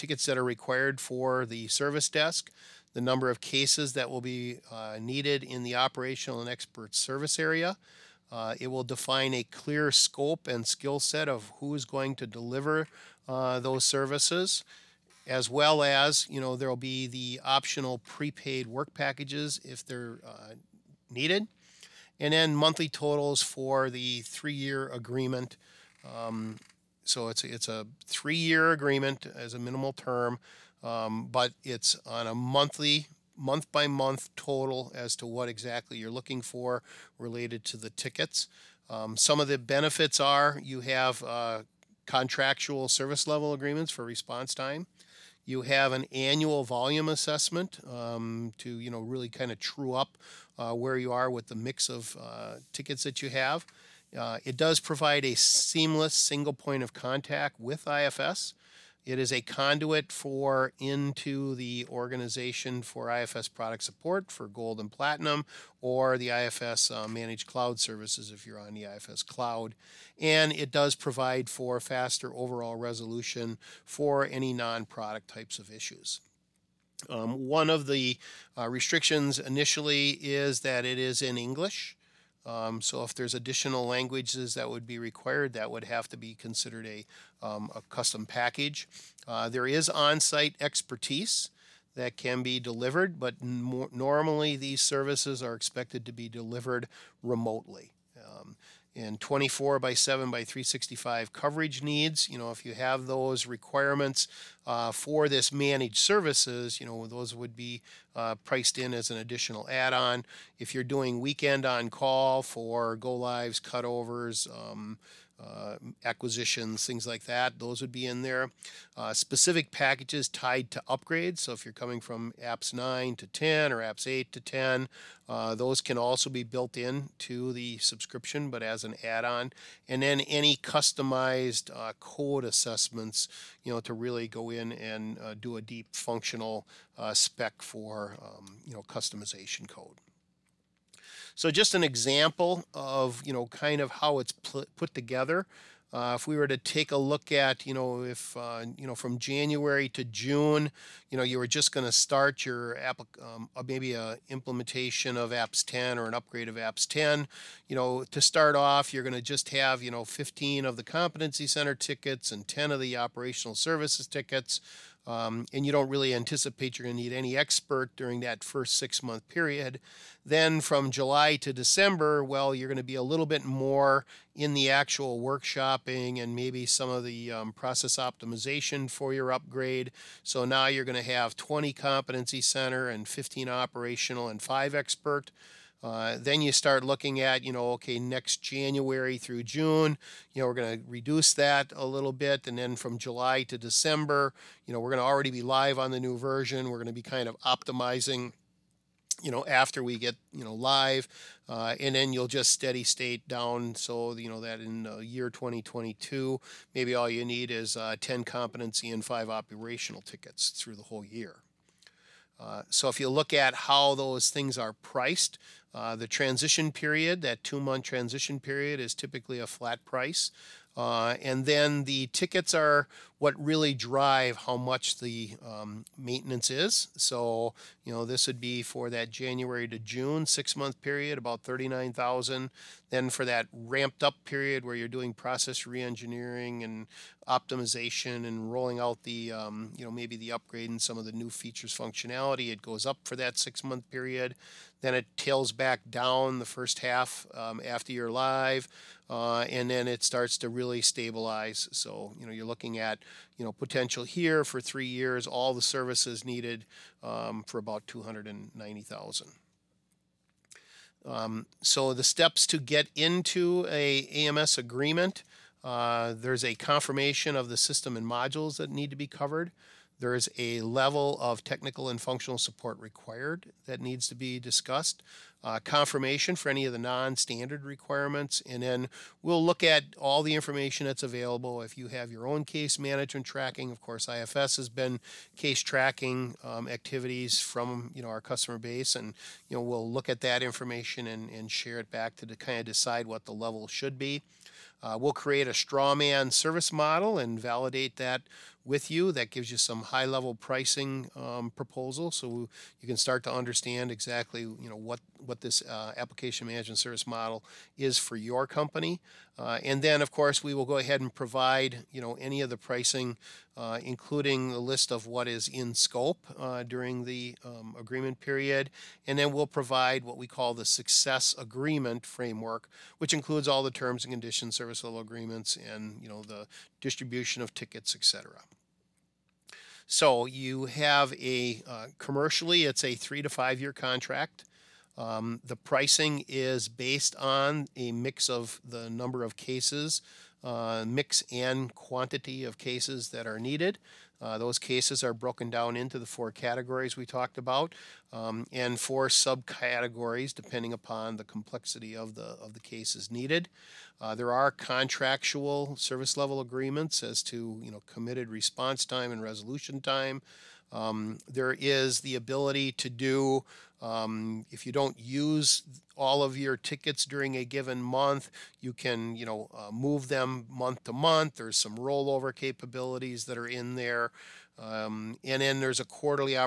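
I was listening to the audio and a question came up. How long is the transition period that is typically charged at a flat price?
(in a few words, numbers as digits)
2 months.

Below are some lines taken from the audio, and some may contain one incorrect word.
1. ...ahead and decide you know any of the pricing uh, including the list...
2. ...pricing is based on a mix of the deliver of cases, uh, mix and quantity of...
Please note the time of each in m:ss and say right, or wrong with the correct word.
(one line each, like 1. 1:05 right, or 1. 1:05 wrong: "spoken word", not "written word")
1. 5:10 wrong: "provide", not "decide"
2. 5:35 wrong: "number", not "deliver".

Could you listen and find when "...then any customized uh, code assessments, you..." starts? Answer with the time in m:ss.
2:10.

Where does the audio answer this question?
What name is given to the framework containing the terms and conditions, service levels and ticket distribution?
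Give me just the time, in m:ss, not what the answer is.
5:20.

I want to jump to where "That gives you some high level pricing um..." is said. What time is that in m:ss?
4:59.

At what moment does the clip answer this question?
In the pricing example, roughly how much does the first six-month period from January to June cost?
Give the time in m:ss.
3:51.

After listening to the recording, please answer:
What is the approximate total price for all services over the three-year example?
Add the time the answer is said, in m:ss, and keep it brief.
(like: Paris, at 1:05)
290,000, at 4:17.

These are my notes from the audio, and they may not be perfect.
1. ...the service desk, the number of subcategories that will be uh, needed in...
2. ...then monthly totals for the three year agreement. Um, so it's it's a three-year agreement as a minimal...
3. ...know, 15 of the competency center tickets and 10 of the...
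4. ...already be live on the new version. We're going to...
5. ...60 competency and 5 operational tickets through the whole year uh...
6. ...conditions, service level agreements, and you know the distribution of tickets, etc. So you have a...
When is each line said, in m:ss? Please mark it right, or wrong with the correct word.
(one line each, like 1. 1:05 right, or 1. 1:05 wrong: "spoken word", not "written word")
1. 0:01 wrong: "cases", not "subcategories"
2. 0:22 right
3. 2:39 right
4. 3:15 right
5. 3:27 wrong: "10", not "60"
6. 5:24 right.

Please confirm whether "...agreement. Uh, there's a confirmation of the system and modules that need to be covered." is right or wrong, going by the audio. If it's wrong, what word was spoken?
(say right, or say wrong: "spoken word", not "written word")
right.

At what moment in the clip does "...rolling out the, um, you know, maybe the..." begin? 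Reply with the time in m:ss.
3:58.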